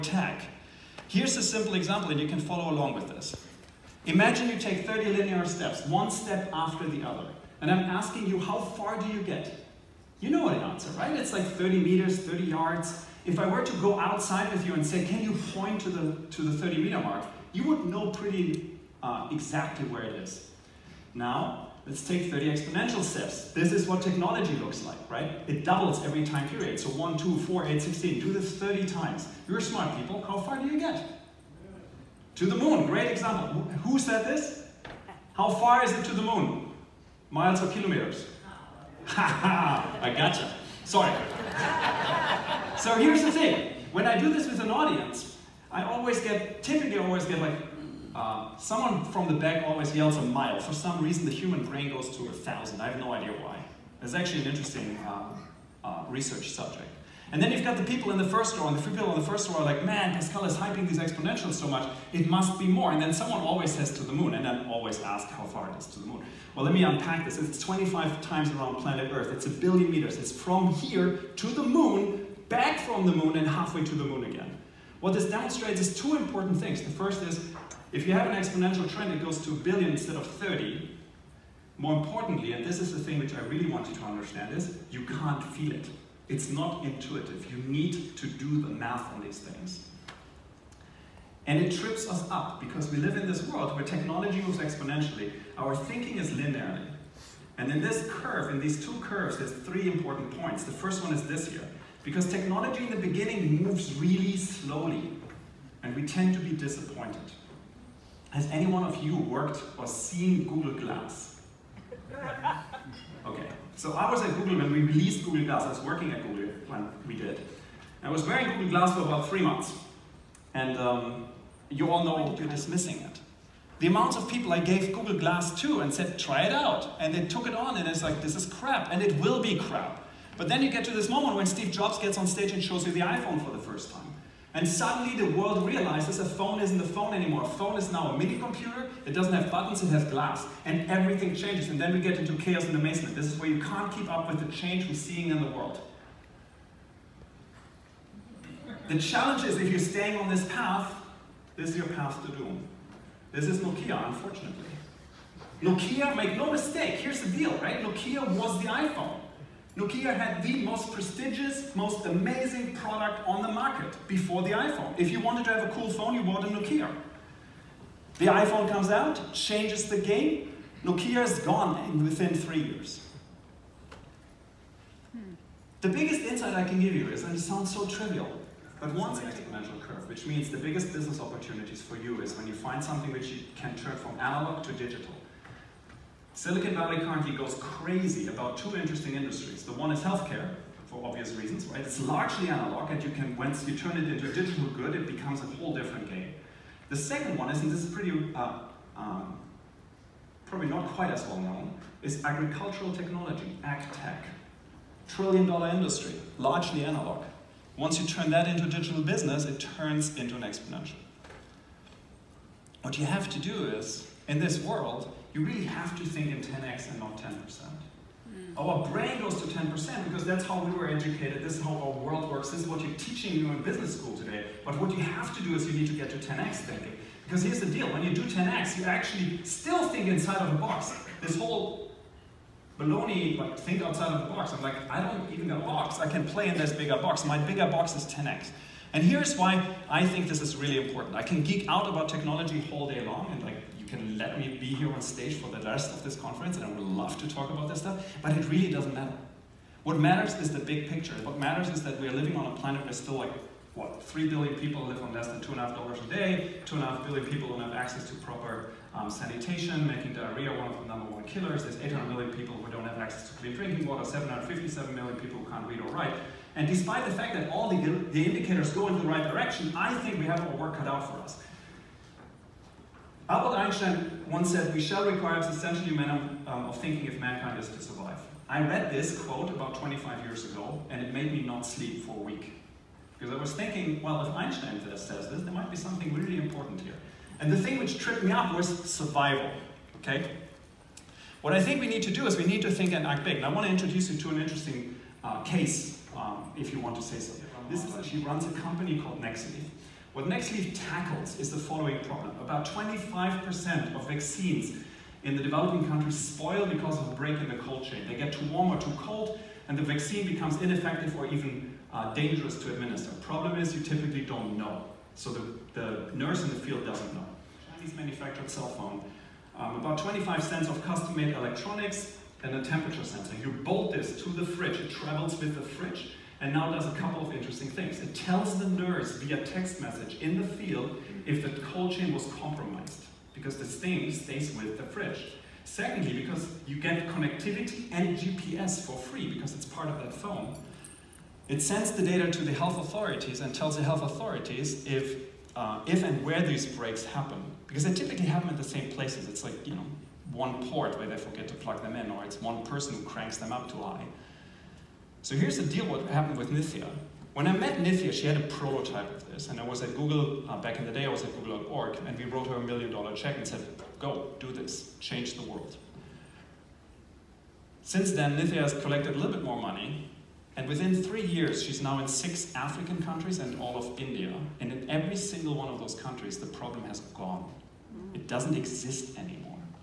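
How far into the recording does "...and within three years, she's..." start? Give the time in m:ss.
6:10.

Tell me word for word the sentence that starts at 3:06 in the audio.
Silicon Valley currently goes crazy about two interesting industries.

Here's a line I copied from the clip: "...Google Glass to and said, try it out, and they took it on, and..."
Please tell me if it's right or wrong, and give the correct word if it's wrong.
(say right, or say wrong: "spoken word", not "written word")
right.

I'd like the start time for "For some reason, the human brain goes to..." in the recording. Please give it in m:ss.
0:50.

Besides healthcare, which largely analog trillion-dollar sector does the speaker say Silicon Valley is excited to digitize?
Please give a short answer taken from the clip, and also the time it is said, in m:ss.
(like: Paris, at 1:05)
Agricultural technology, at 3:22.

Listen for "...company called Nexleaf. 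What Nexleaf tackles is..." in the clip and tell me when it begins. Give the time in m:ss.
4:58.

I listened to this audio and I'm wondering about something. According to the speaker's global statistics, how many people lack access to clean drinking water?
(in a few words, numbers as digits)
800 million.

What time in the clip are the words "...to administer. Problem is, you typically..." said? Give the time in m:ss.
5:12.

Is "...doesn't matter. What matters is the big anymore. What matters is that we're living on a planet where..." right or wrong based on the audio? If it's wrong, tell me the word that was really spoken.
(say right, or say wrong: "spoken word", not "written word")
wrong: "picture", not "anymore".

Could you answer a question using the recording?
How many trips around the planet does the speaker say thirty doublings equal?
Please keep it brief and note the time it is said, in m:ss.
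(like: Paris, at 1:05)
25, at 1:07.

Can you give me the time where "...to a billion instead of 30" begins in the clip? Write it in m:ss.
1:19.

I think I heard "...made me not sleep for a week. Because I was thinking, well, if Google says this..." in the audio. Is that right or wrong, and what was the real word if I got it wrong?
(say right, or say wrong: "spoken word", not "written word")
wrong: "Einstein", not "Google".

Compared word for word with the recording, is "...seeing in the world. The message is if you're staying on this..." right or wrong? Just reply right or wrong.
wrong.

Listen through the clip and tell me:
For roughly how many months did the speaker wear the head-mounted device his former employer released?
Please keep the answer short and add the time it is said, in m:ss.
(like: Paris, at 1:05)
3 months, at 1:59.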